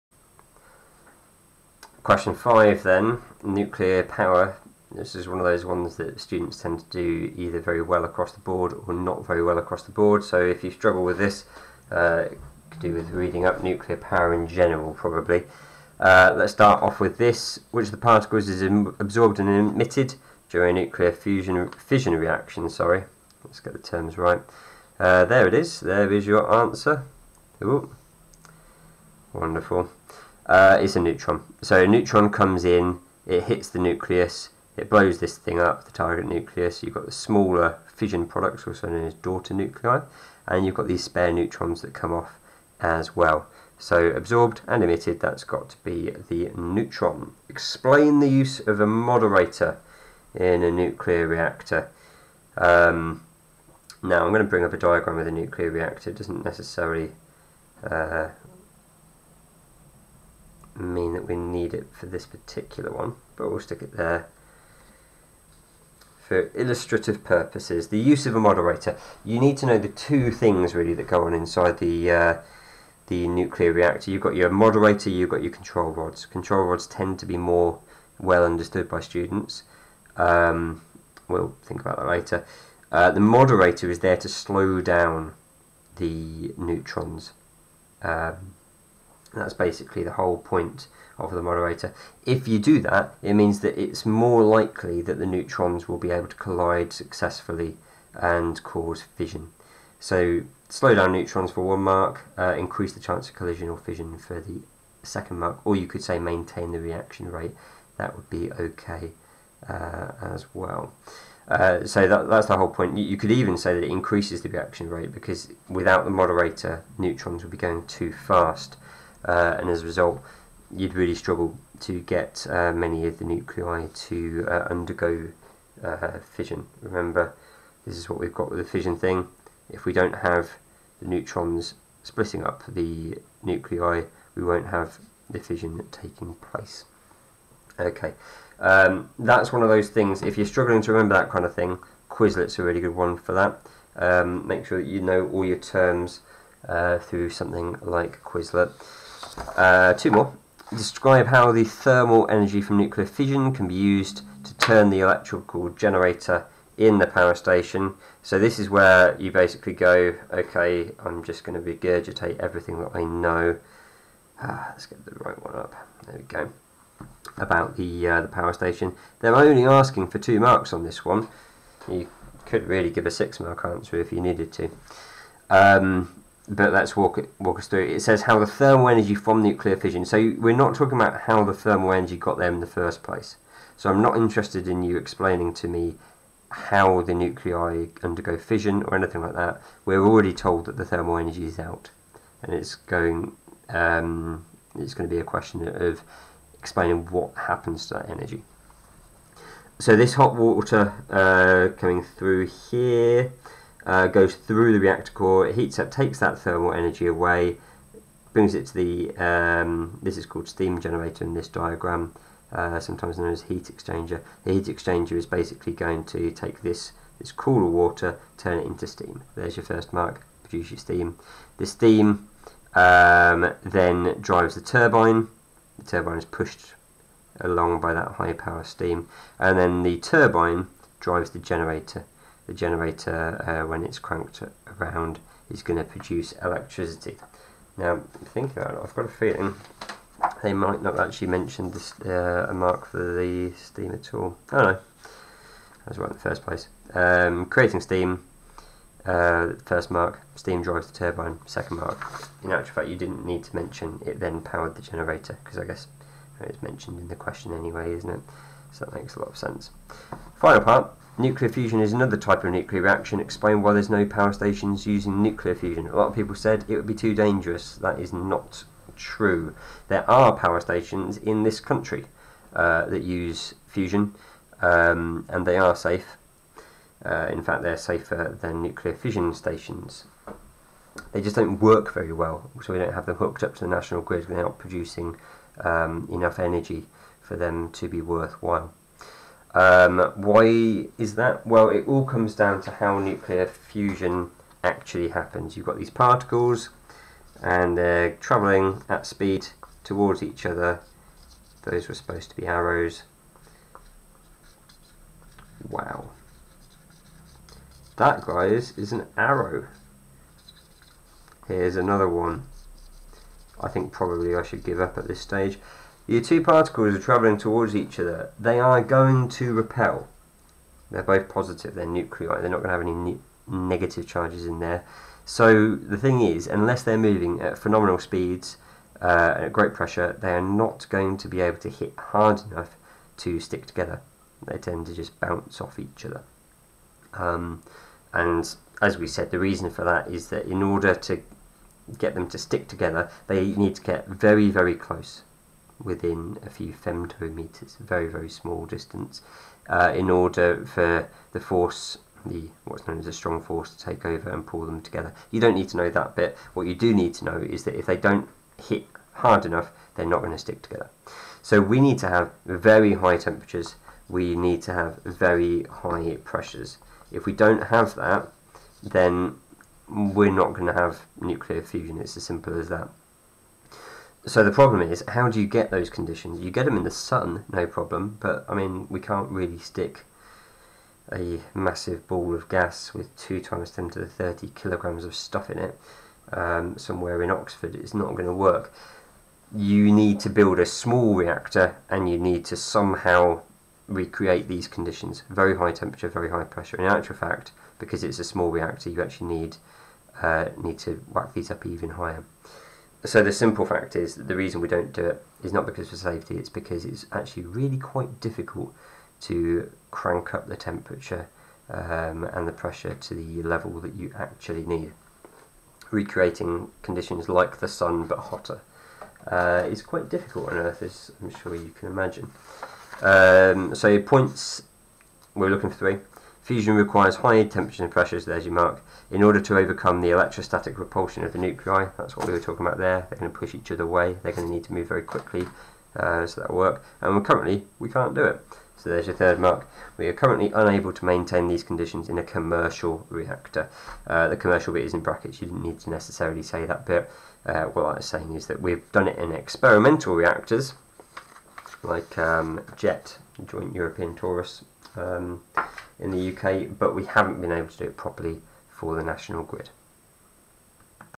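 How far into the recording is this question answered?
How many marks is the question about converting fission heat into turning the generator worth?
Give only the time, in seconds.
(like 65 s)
170 s.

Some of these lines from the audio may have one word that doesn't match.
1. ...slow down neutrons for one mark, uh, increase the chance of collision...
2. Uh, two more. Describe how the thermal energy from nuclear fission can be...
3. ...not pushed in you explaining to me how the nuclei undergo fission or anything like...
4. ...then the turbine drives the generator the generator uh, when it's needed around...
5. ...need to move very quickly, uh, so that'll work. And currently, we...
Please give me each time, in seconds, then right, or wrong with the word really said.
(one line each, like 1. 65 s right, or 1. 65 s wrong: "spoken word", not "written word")
1. 100 s right
2. 149 s right
3. 184 s wrong: "interested", not "pushed"
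4. 229 s wrong: "cranked", not "needed"
5. 434 s right.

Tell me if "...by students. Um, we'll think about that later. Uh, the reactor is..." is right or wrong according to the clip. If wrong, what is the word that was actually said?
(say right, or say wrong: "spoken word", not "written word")
wrong: "moderator", not "reactor".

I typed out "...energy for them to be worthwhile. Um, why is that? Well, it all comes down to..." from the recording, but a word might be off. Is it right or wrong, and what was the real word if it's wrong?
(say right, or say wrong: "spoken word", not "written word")
right.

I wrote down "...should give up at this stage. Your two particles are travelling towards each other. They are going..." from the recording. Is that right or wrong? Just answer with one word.
right.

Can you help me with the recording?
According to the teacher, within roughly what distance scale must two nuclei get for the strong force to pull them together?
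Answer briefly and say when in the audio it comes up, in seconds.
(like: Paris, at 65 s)
a few femtometers, at 346 s.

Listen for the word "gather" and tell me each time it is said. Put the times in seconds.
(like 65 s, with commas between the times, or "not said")
not said.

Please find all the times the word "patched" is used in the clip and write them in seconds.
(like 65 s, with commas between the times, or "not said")
not said.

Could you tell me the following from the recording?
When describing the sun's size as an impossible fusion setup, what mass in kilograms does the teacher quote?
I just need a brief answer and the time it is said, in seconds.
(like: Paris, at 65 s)
2 x 10^30 kg, at 383 s.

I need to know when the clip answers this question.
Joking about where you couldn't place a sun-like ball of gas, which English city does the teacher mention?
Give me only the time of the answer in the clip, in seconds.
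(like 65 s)
387 s.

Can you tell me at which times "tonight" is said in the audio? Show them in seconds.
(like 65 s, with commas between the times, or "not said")
not said.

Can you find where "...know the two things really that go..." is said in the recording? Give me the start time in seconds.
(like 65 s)
69 s.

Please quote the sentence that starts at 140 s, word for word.
If you're struggling to remember that kind of thing, Quizlet's a really good one for that.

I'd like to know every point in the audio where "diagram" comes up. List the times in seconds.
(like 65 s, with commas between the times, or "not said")
54 s, 211 s.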